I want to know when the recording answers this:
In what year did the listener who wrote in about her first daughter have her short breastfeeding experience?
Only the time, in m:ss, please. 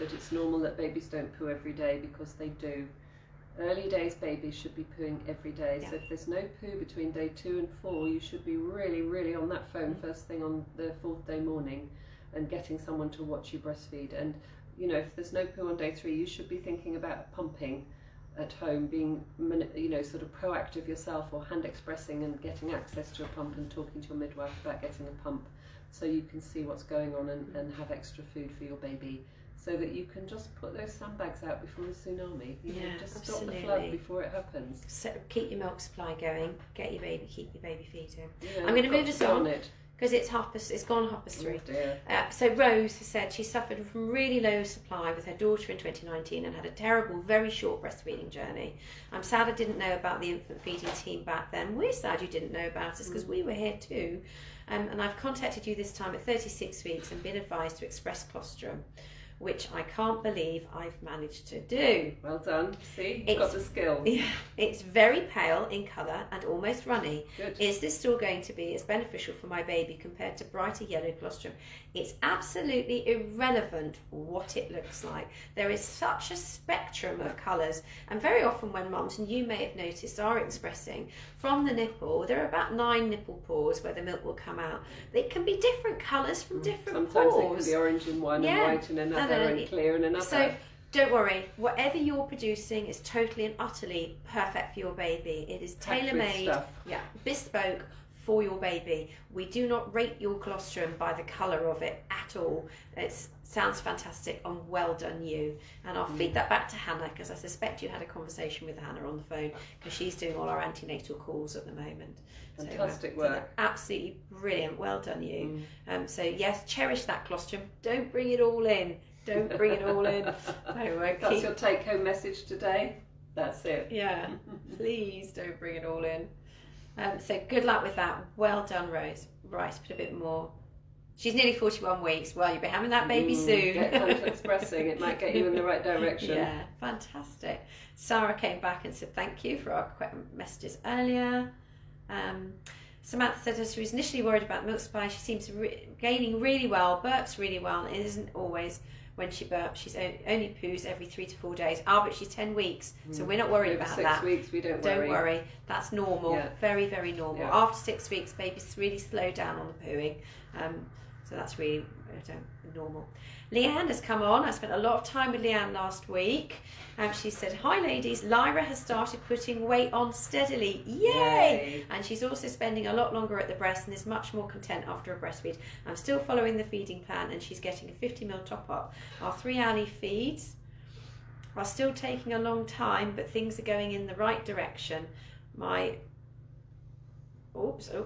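0:45.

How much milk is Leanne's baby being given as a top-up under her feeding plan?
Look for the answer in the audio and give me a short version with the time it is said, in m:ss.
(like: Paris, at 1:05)
50 ml, at 2:57.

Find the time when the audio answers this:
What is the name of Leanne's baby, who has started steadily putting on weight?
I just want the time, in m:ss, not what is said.
2:48.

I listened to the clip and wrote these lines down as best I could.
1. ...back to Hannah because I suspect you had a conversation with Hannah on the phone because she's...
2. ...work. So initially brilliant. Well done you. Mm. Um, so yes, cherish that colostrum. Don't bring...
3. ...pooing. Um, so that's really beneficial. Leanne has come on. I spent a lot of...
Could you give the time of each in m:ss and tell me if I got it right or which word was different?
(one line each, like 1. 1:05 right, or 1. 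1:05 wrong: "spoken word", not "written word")
1. 1:46 right
2. 1:53 wrong: "absolutely", not "initially"
3. 2:39 wrong: "normal", not "beneficial".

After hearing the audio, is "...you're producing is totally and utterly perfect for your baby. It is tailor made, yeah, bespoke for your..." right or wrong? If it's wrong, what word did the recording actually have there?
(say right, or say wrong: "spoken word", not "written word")
right.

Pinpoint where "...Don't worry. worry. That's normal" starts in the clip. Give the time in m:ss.
2:34.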